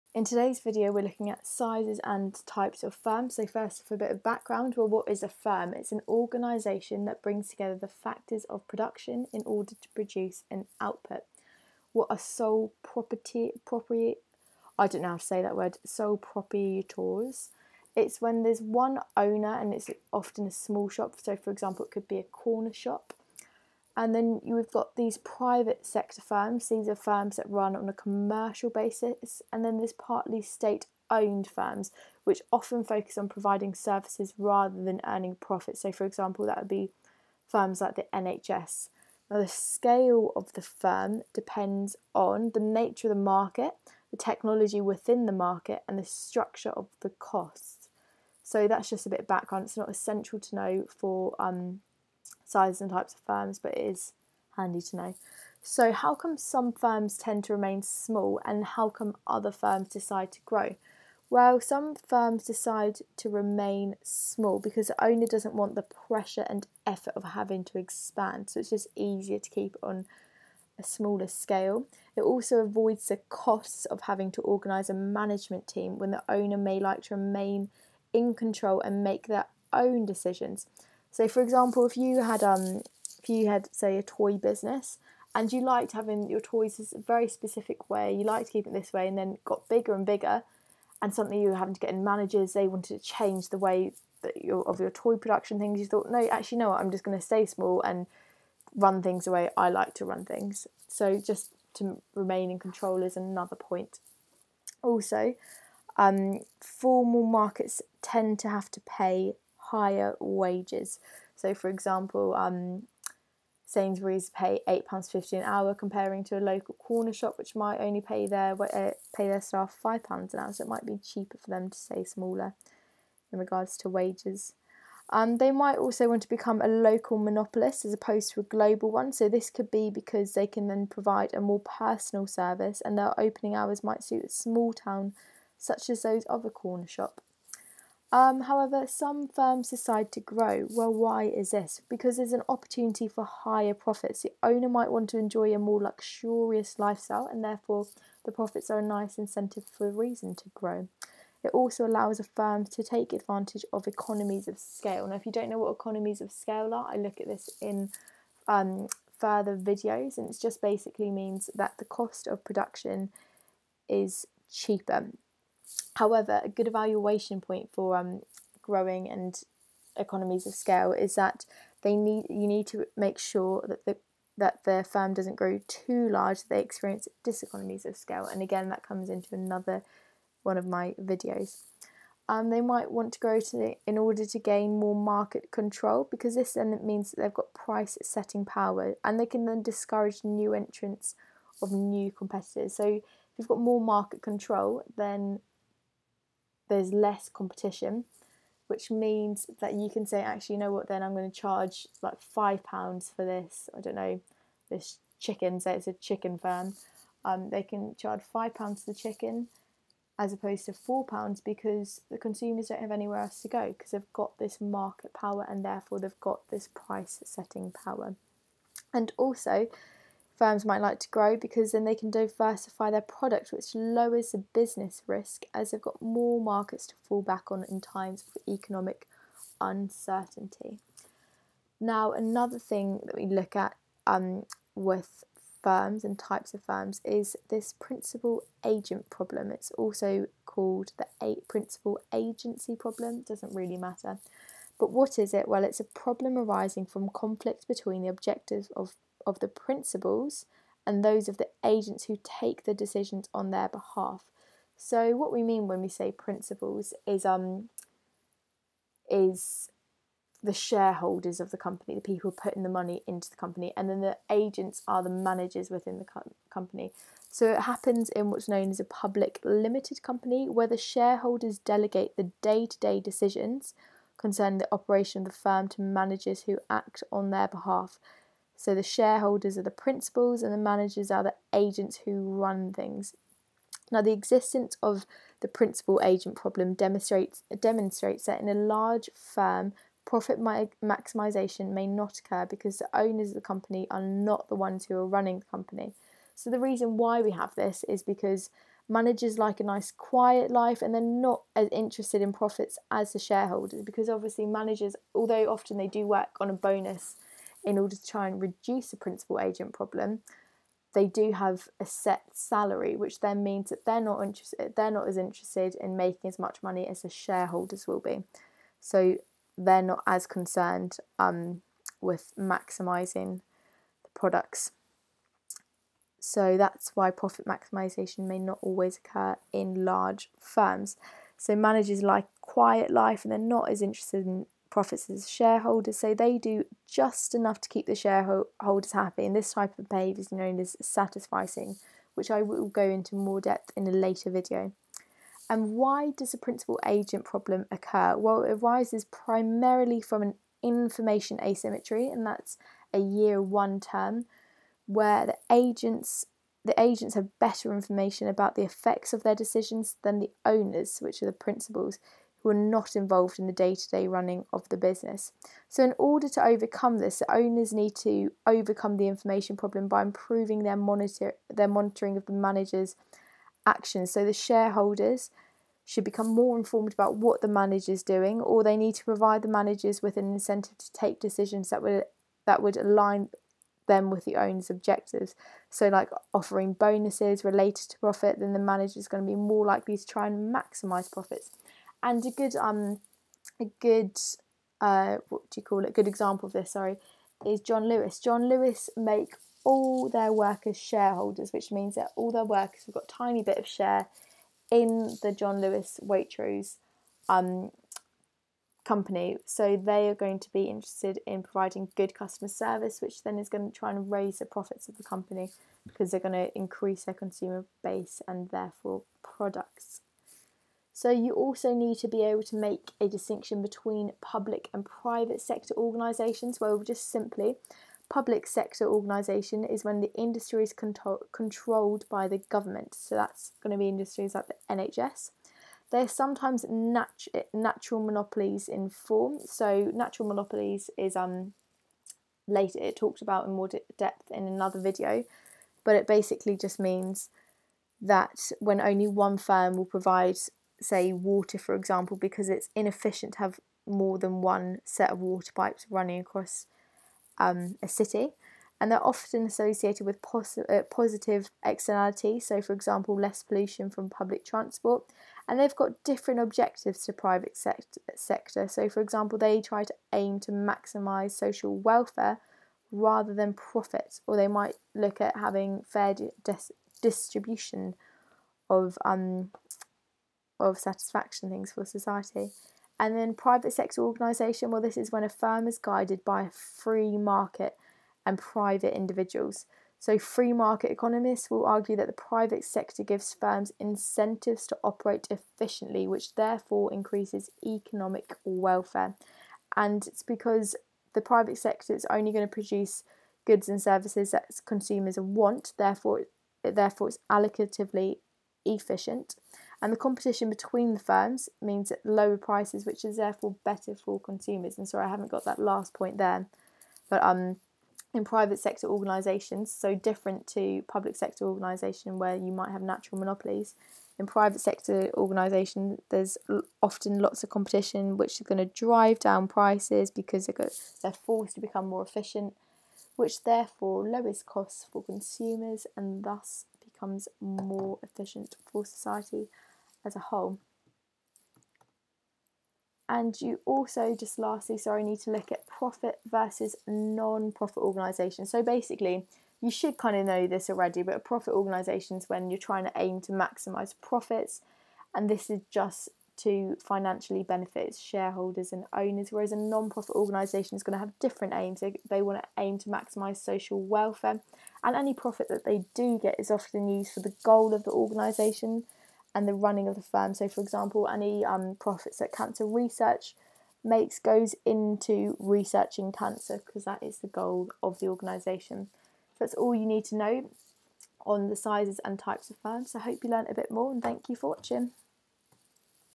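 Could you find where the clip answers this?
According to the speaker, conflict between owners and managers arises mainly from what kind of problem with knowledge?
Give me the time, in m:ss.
5:50.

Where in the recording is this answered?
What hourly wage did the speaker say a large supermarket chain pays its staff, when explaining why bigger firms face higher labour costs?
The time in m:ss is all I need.
1:54.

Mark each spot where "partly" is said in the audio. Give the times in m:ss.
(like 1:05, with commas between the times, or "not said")
0:29.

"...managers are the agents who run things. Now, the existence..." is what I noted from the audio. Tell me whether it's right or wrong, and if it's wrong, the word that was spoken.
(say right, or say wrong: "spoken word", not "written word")
right.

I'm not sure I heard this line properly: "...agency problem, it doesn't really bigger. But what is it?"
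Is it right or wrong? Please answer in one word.
wrong.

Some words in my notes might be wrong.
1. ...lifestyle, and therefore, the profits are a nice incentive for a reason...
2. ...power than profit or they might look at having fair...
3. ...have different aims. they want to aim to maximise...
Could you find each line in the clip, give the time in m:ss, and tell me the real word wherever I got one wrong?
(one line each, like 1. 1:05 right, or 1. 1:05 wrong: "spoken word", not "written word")
1. 2:26 right
2. 7:52 wrong: "rather", not "power"
3. 9:21 right.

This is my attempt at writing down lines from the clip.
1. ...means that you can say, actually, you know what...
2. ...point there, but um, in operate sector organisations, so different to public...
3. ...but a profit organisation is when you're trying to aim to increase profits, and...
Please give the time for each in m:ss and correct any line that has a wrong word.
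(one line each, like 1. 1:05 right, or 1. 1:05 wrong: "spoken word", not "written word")
1. 3:18 right
2. 8:35 wrong: "private", not "operate"
3. 9:11 wrong: "maximise", not "increase".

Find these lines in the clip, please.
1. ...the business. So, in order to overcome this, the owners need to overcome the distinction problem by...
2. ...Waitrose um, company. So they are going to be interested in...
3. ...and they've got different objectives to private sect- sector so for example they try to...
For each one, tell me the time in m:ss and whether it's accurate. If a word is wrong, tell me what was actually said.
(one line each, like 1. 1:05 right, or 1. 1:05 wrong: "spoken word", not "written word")
1. 6:04 wrong: "information", not "distinction"
2. 6:46 right
3. 7:45 right.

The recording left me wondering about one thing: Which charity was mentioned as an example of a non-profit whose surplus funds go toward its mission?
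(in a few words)
Cancer Research.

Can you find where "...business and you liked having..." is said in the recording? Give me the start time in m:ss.
1:24.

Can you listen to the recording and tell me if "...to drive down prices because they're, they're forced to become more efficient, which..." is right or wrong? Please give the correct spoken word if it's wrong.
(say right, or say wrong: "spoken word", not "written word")
right.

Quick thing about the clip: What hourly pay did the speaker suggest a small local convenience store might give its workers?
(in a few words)
£5.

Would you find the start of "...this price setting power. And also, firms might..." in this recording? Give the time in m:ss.
3:36.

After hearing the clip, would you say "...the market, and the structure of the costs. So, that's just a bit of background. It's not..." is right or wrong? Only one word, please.
right.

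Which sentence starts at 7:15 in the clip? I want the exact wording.
They're sometimes nat- natural monopolies in form.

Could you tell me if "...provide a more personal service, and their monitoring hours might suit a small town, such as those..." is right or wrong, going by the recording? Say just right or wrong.
wrong.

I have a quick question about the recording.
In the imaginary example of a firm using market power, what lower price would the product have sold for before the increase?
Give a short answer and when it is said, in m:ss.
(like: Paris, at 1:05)
£4, at 3:30.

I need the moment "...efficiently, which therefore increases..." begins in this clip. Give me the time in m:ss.
8:15.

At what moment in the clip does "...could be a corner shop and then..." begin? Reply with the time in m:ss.
0:21.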